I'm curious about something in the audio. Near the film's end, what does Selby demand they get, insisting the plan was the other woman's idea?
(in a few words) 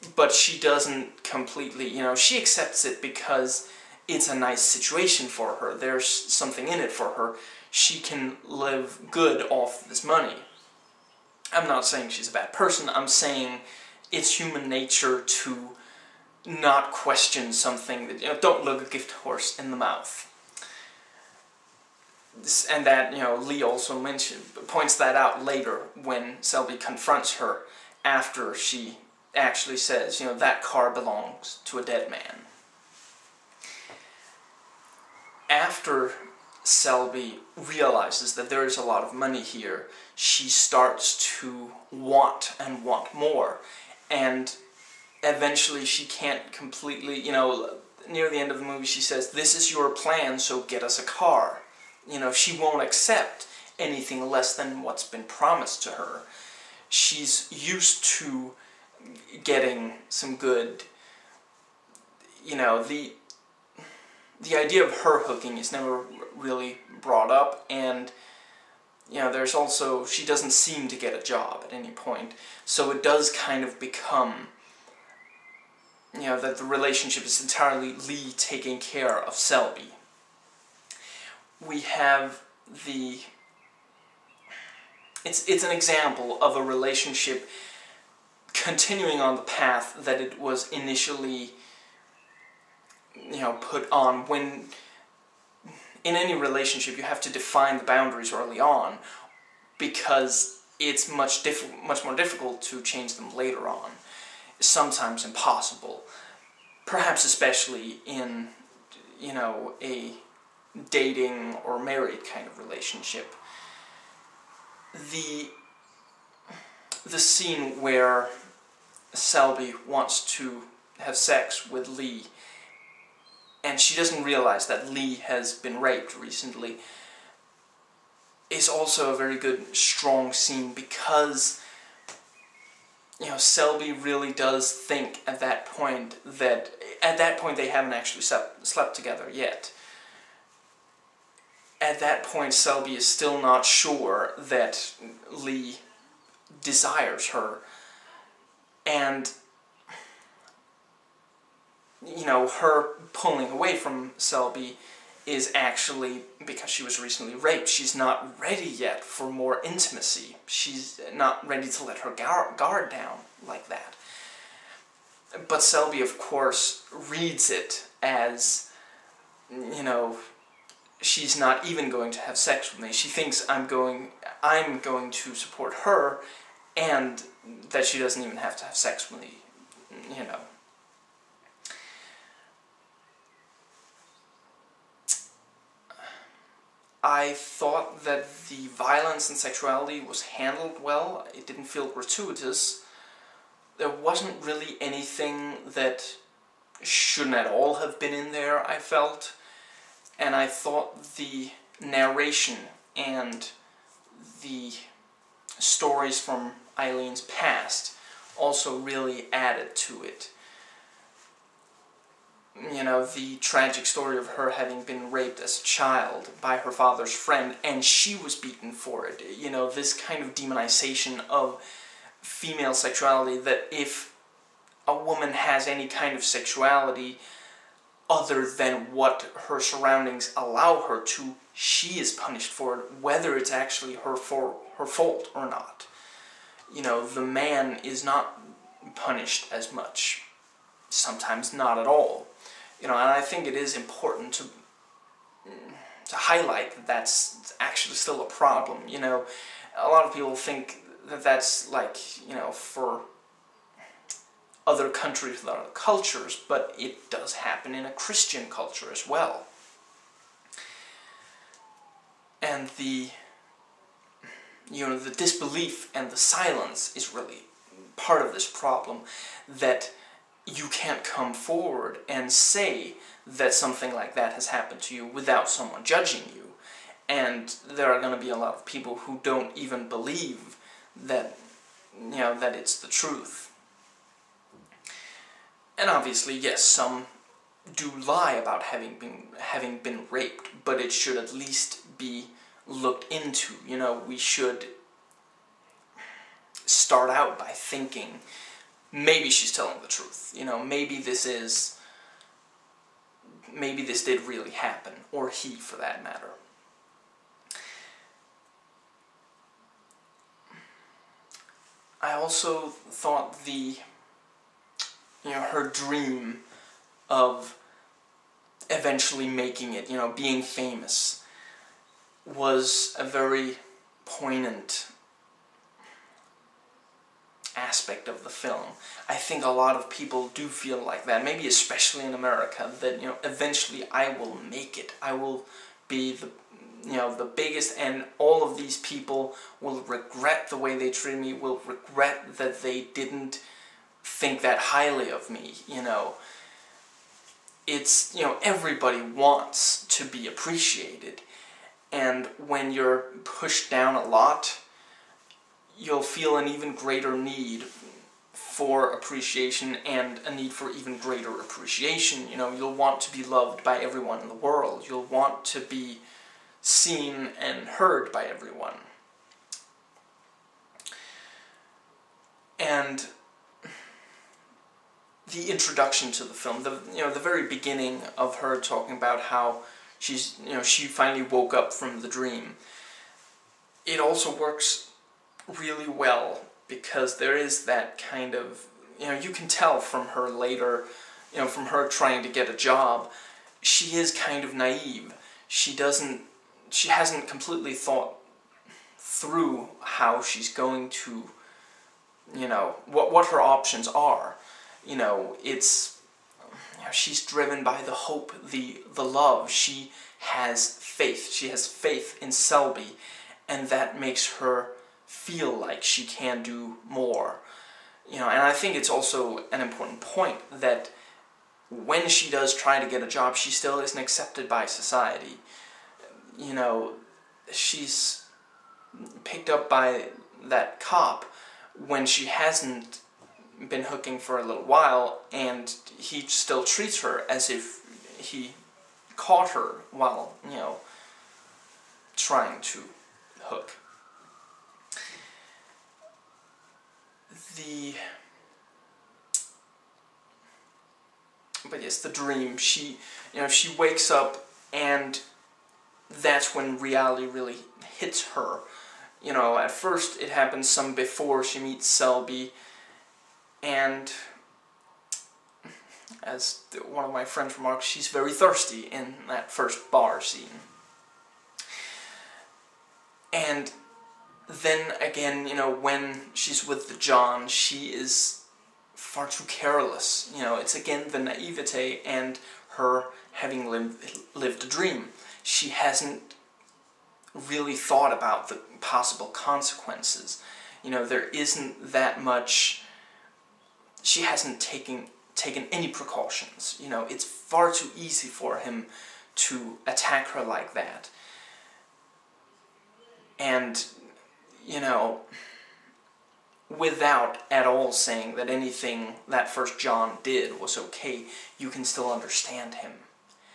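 A car.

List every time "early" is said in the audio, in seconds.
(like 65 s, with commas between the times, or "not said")
98 s.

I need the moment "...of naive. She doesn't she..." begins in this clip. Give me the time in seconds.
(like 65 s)
394 s.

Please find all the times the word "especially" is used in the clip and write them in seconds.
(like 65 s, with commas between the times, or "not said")
107 s, 331 s.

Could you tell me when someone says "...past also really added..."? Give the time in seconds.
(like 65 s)
207 s.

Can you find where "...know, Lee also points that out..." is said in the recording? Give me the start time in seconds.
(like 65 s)
23 s.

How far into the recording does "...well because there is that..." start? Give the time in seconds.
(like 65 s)
385 s.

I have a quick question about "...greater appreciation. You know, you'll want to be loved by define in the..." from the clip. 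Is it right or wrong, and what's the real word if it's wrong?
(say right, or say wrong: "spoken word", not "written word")
wrong: "everyone", not "define".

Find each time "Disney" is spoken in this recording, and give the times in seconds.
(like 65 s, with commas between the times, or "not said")
not said.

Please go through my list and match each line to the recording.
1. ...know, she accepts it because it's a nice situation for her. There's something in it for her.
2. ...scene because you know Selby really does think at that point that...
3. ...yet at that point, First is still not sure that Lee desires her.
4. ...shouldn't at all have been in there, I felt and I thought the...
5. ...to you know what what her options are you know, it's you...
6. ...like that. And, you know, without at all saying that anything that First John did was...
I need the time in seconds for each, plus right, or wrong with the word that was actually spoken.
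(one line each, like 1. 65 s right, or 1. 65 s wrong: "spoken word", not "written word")
1. 2 s right
2. 130 s right
3. 139 s wrong: "Selby", not "First"
4. 196 s right
5. 400 s right
6. 500 s right.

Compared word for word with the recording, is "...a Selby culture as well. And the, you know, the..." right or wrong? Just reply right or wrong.
wrong.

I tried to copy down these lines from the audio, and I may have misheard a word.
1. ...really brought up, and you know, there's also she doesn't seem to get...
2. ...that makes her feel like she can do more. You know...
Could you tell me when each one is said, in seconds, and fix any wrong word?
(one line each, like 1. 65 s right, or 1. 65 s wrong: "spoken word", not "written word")
1. 66 s right
2. 413 s right.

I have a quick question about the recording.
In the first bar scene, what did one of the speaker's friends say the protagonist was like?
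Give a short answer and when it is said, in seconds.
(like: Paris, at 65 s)
Very thirsty, at 468 s.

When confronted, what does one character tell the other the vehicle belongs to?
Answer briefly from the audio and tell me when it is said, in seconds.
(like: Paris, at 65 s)
A dead man, at 31 s.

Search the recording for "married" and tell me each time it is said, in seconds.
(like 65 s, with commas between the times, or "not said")
111 s.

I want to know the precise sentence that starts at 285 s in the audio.
And obviously, yes, some do lie about having been having been raped, but it should at least be looked into.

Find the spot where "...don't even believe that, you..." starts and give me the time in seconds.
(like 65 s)
279 s.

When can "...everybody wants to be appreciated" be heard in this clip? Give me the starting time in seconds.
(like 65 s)
348 s.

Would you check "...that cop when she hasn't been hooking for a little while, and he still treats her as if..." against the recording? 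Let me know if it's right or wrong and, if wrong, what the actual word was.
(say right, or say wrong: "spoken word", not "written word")
right.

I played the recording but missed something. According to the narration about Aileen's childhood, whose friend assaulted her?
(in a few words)
Her father's friend.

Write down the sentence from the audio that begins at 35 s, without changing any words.
After Selby realizes that there is a lot of money here, she starts to want and want more.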